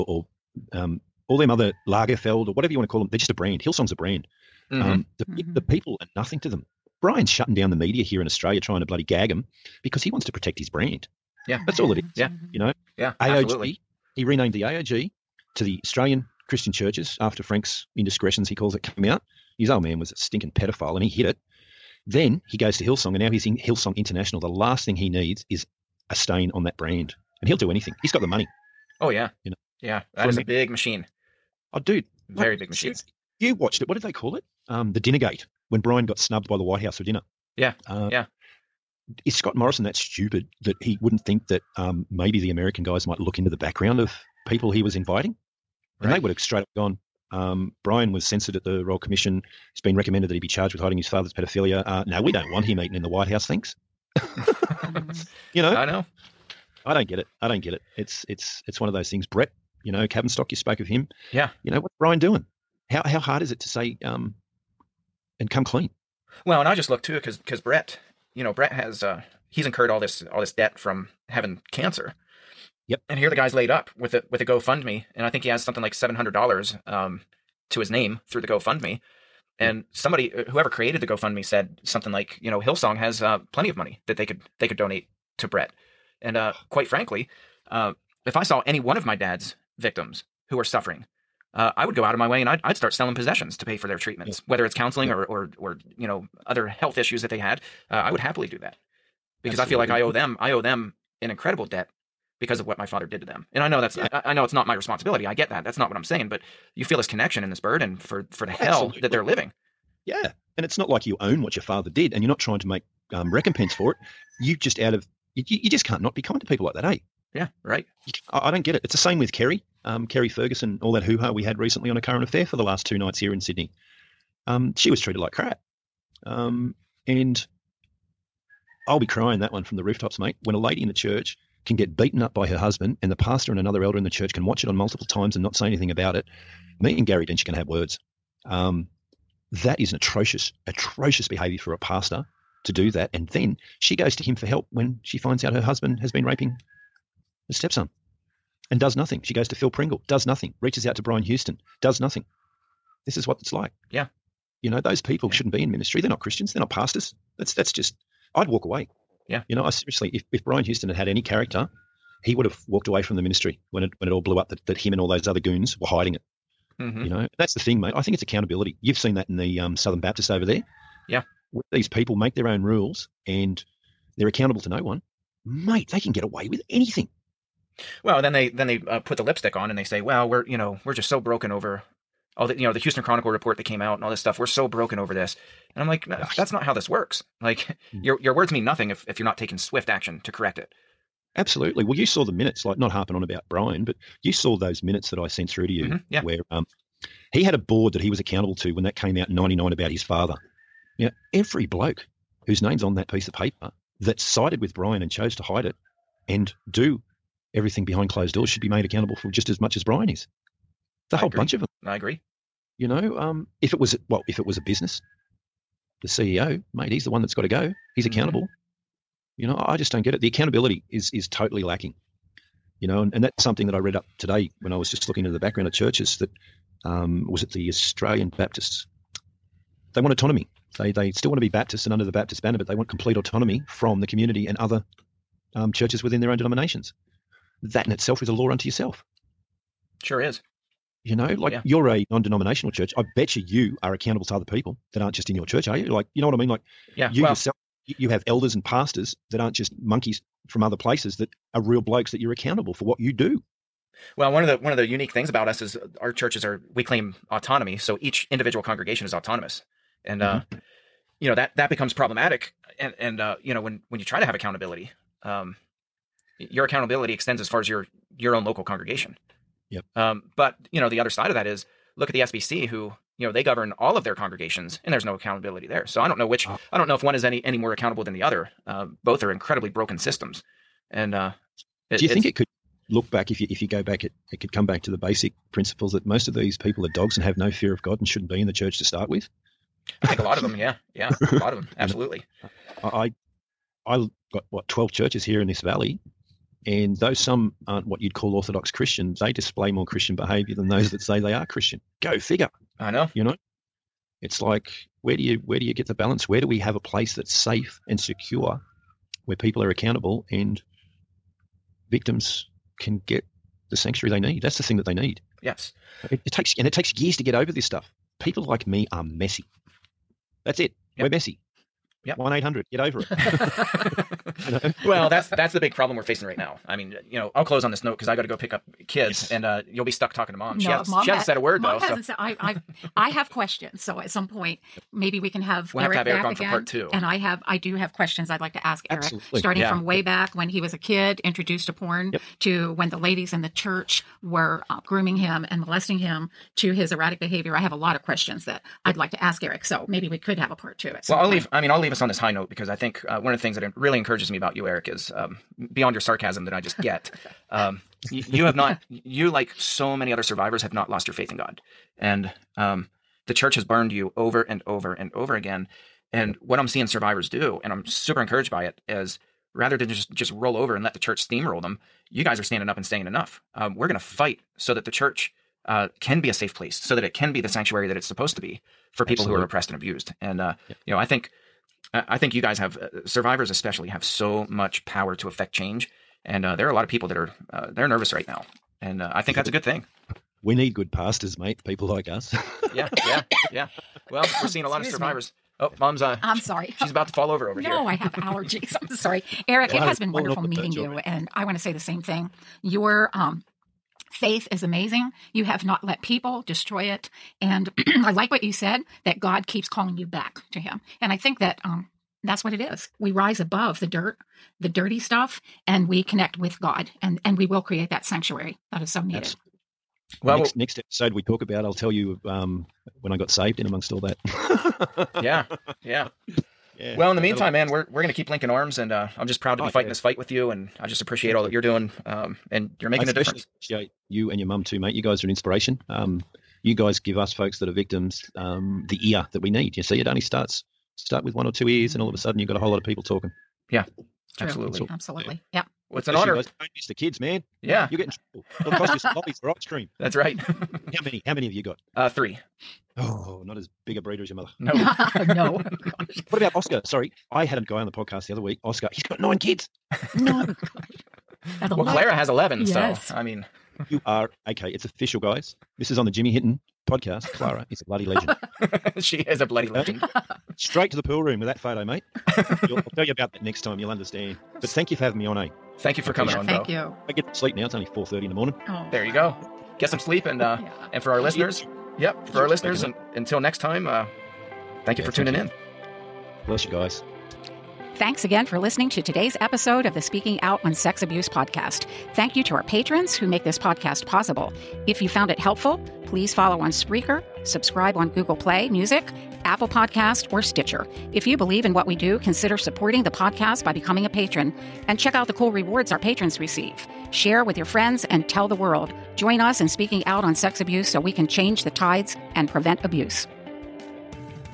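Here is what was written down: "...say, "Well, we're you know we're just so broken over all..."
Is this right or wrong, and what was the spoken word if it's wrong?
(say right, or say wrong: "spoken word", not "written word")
right.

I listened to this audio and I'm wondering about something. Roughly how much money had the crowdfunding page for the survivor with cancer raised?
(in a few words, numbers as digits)
$700.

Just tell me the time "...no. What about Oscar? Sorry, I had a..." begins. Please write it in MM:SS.
07:35.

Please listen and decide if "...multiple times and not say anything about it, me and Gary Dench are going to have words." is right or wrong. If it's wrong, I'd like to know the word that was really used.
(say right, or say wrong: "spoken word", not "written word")
right.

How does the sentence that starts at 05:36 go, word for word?
And I have I do have questions I'd like to ask Erik, starting yeah.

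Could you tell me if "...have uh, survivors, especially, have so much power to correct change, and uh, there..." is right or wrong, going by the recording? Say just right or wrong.
wrong.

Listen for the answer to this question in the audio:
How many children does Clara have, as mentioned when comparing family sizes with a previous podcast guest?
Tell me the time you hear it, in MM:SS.
07:42.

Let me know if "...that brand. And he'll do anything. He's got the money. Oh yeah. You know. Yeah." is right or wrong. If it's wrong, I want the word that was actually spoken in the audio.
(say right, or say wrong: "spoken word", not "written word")
right.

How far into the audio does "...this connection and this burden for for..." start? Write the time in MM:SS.
01:46.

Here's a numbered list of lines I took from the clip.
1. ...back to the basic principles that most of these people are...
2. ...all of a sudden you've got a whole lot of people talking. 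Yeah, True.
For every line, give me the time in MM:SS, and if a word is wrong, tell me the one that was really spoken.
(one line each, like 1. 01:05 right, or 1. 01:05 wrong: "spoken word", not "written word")
1. 04:44 right
2. 07:21 right.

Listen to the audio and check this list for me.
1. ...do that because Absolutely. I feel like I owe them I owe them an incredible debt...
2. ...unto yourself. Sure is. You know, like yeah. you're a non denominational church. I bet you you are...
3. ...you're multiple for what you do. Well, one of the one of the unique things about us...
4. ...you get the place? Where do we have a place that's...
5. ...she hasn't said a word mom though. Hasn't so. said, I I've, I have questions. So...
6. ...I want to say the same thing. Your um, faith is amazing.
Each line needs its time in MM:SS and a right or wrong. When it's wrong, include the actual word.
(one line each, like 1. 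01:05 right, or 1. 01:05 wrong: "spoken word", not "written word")
1. 01:38 right
2. 03:58 right
3. 04:12 wrong: "accountable", not "multiple"
4. 05:05 wrong: "balance", not "place"
5. 05:31 right
6. 06:41 right.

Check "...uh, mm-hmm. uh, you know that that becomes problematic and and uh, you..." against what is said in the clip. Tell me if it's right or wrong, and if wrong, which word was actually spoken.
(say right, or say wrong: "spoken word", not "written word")
right.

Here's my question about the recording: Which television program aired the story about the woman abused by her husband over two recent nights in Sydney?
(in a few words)
A Current Affair.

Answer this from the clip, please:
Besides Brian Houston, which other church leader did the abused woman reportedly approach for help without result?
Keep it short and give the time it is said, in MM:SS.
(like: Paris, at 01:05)
Phil Pringle, at 02:29.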